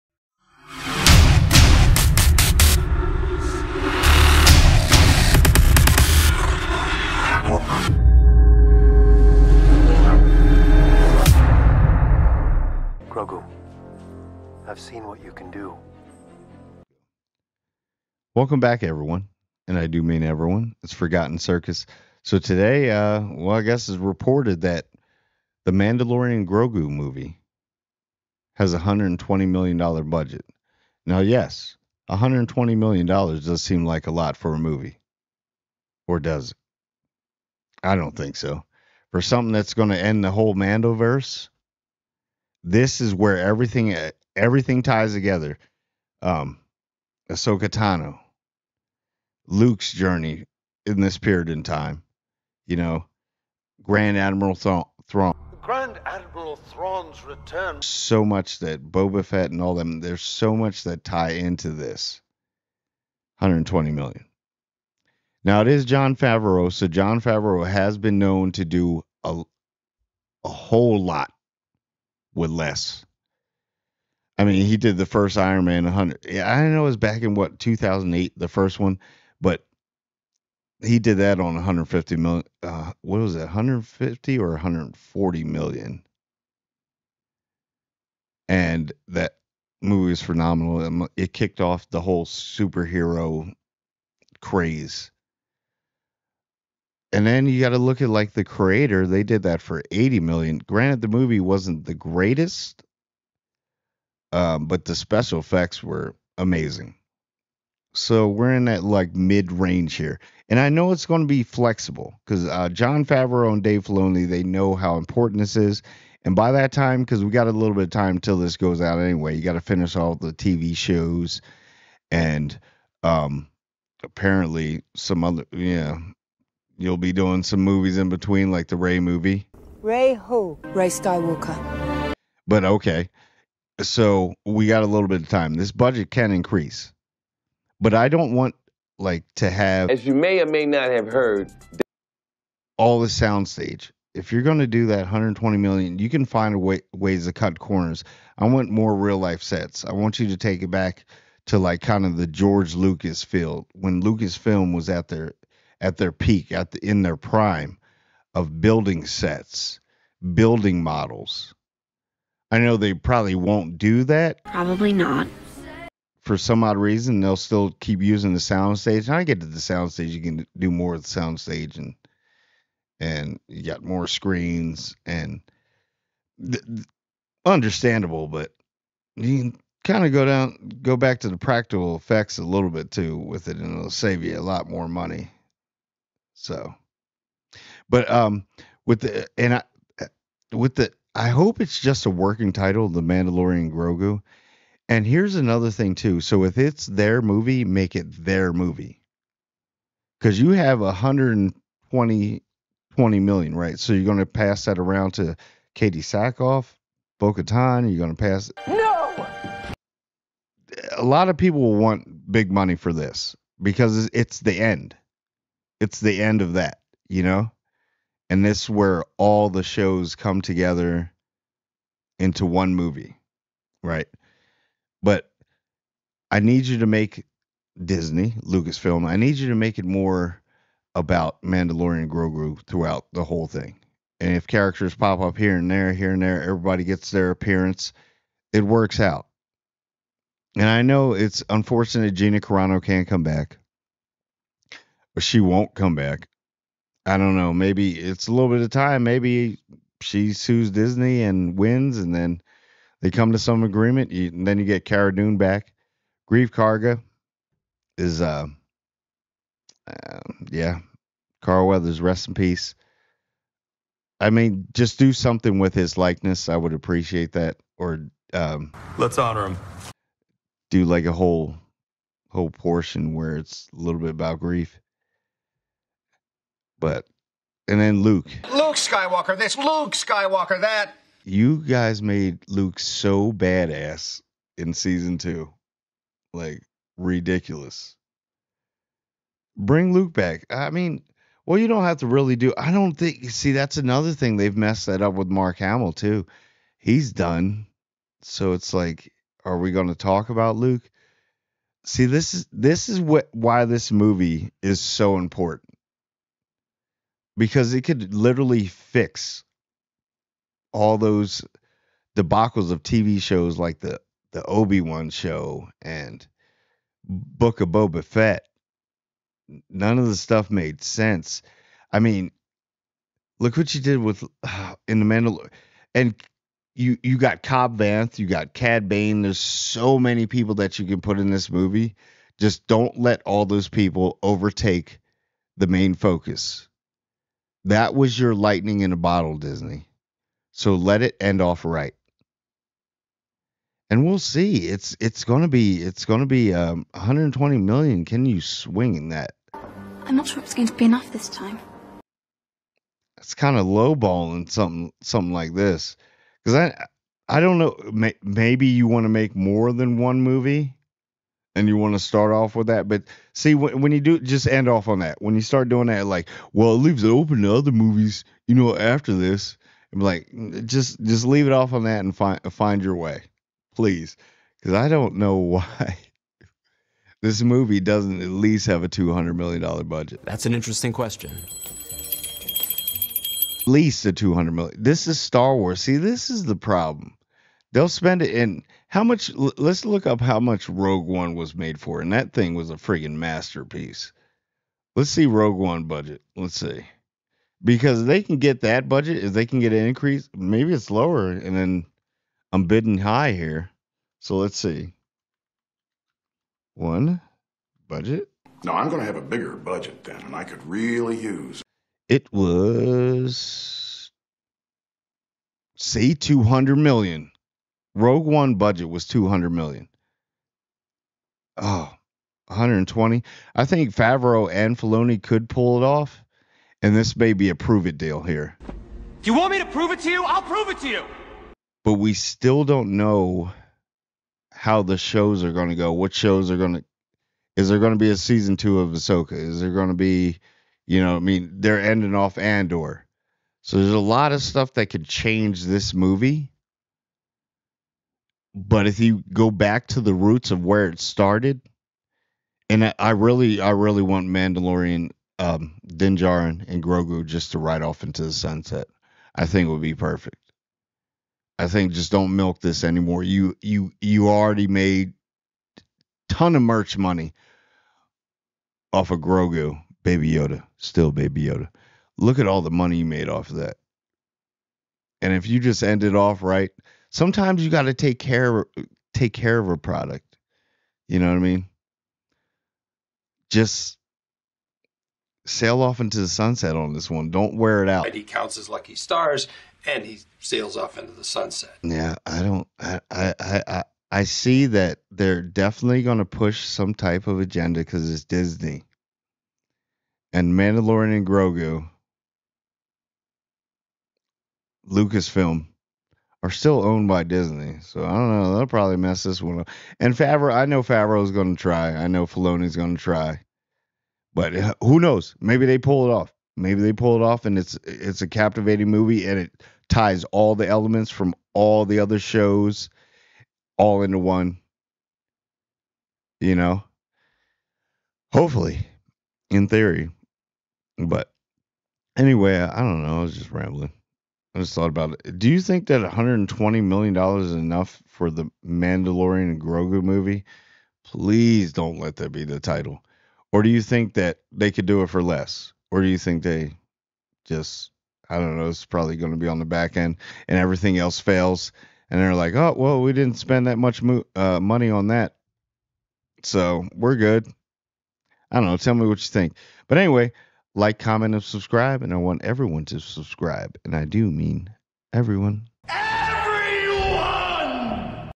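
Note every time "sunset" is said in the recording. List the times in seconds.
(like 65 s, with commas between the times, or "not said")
458 s, 486 s, 491 s.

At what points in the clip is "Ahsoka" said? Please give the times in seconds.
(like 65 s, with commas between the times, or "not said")
47 s, 438 s.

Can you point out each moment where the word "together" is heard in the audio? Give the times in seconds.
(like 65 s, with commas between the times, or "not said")
45 s, 220 s.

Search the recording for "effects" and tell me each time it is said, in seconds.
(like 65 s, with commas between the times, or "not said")
105 s, 181 s.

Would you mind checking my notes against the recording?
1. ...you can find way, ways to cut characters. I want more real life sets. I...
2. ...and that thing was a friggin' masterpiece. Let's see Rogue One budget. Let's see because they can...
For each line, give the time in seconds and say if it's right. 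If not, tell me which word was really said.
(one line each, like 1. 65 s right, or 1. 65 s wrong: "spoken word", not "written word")
1. 145 s wrong: "corners", not "characters"
2. 391 s right.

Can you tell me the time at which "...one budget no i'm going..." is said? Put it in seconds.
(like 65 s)
406 s.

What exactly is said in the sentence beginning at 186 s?
So, but um, with the and I uh, with the I hope it's just a working title, The Mandalorian Grogu.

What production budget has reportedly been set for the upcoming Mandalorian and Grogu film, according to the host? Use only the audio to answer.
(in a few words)
$120 million.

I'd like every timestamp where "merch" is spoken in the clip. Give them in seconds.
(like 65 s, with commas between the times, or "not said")
466 s.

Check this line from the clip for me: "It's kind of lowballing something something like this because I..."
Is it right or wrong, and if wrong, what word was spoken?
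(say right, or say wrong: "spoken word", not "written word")
right.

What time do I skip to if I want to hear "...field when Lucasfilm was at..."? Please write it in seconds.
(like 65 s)
153 s.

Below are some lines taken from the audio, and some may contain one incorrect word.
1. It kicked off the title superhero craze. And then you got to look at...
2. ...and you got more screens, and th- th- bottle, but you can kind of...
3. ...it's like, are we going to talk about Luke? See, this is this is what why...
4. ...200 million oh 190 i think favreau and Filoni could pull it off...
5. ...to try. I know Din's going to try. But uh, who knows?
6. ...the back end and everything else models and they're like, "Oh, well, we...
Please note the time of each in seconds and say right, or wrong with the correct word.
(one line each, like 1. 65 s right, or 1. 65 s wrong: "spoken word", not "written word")
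1. 91 s wrong: "whole", not "title"
2. 172 s wrong: "understandable", not "bottle"
3. 298 s right
4. 419 s wrong: "120", not "190"
5. 511 s wrong: "Filoni", not "Din"
6. 549 s wrong: "fails", not "models".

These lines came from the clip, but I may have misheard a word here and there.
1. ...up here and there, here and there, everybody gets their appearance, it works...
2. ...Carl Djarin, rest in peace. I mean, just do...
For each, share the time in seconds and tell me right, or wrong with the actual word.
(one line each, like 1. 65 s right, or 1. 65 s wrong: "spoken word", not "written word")
1. 235 s right
2. 261 s wrong: "Weathers", not "Djarin".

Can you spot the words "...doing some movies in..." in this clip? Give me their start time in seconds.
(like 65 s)
127 s.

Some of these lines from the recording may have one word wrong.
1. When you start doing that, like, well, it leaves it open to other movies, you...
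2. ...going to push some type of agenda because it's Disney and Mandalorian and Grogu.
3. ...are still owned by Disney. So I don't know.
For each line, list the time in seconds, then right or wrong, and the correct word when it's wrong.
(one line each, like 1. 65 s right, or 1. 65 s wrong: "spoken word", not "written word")
1. 365 s right
2. 496 s right
3. 506 s right.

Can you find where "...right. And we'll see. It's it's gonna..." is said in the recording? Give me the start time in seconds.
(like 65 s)
341 s.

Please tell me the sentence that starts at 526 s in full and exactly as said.
You know, hopefully, in theory, but anyway, I don't know.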